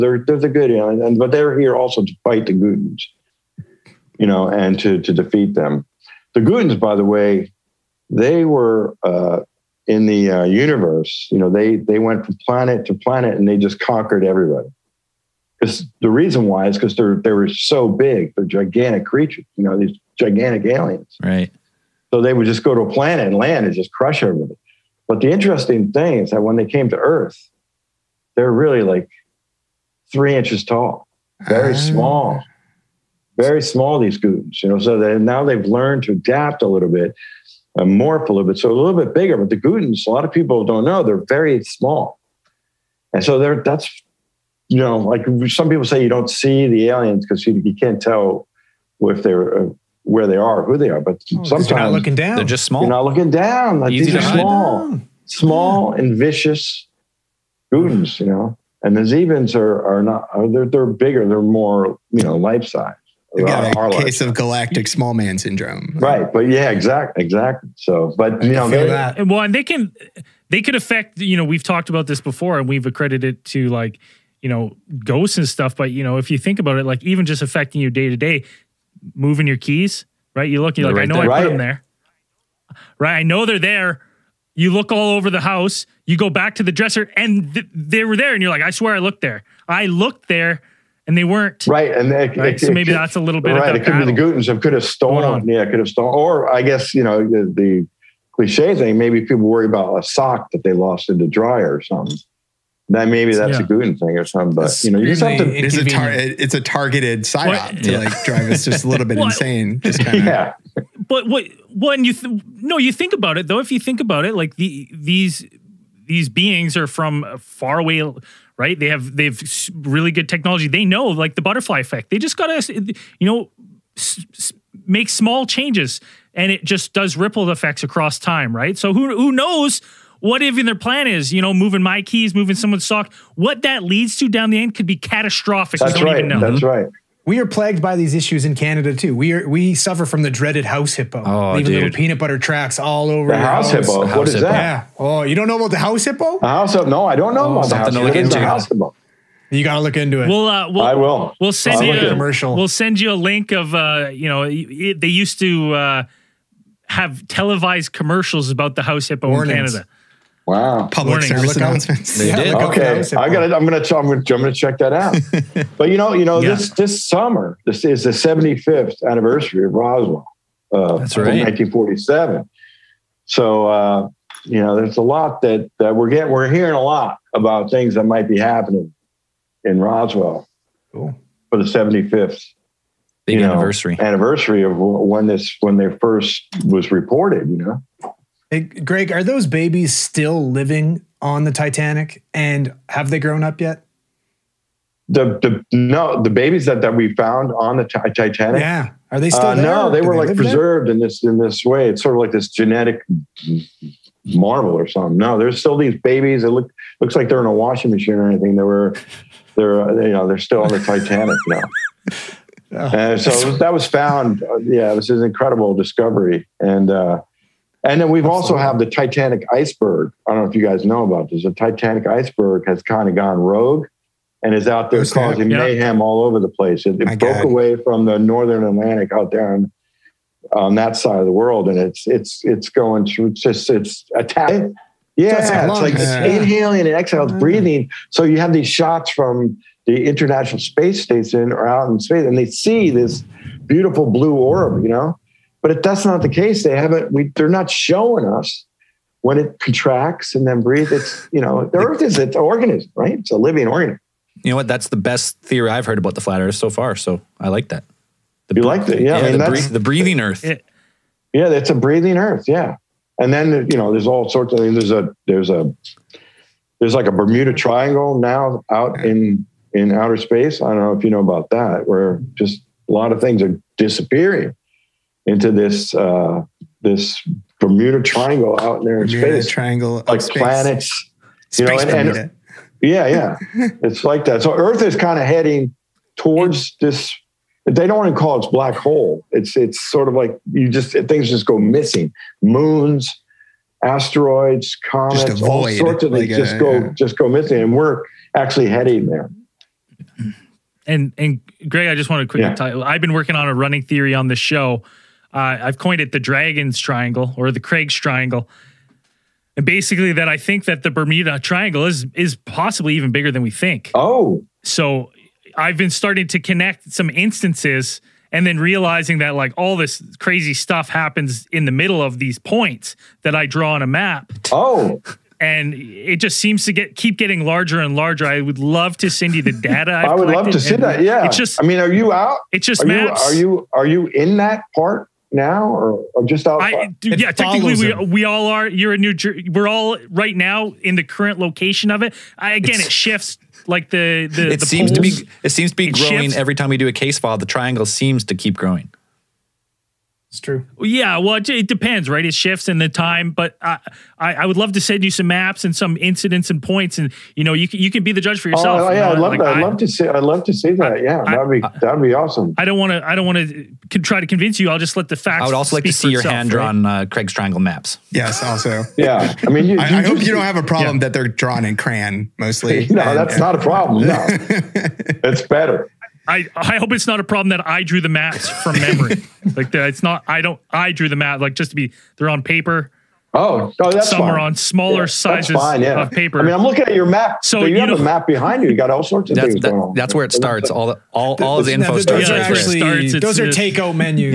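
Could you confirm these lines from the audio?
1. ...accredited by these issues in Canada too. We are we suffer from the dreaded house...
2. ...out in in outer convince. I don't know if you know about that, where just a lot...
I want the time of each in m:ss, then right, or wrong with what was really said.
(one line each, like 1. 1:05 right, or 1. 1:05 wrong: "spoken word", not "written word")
1. 2:17 wrong: "plagued", not "accredited"
2. 4:28 wrong: "space", not "convince".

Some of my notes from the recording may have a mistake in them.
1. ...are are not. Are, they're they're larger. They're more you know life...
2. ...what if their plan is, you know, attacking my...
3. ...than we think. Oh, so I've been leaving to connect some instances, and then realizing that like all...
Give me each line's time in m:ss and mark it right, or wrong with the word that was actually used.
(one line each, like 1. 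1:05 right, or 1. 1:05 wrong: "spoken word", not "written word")
1. 0:59 wrong: "bigger", not "larger"
2. 2:10 wrong: "moving", not "attacking"
3. 5:13 wrong: "starting", not "leaving".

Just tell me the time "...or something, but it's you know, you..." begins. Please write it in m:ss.
1:44.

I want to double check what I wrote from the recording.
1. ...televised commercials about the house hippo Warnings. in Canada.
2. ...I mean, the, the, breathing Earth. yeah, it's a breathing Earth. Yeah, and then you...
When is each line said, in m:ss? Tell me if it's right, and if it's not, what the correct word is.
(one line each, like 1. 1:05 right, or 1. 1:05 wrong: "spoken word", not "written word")
1. 2:37 right
2. 4:19 right.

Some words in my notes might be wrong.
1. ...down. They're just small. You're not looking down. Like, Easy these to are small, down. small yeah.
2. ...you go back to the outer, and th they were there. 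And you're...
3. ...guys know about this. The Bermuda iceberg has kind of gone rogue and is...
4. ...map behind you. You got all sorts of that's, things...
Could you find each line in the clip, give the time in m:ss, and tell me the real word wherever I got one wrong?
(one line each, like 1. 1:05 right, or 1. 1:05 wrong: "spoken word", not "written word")
1. 0:52 right
2. 1:26 wrong: "dresser", not "outer"
3. 3:40 wrong: "Titanic", not "Bermuda"
4. 6:28 right.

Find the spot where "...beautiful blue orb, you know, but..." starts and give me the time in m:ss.
4:03.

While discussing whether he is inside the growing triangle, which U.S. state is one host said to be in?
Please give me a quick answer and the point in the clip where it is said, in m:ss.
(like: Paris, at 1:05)
New Jersey, at 5:39.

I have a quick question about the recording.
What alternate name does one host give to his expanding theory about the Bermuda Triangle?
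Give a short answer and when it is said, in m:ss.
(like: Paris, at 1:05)
Dragons Triangle, at 5:06.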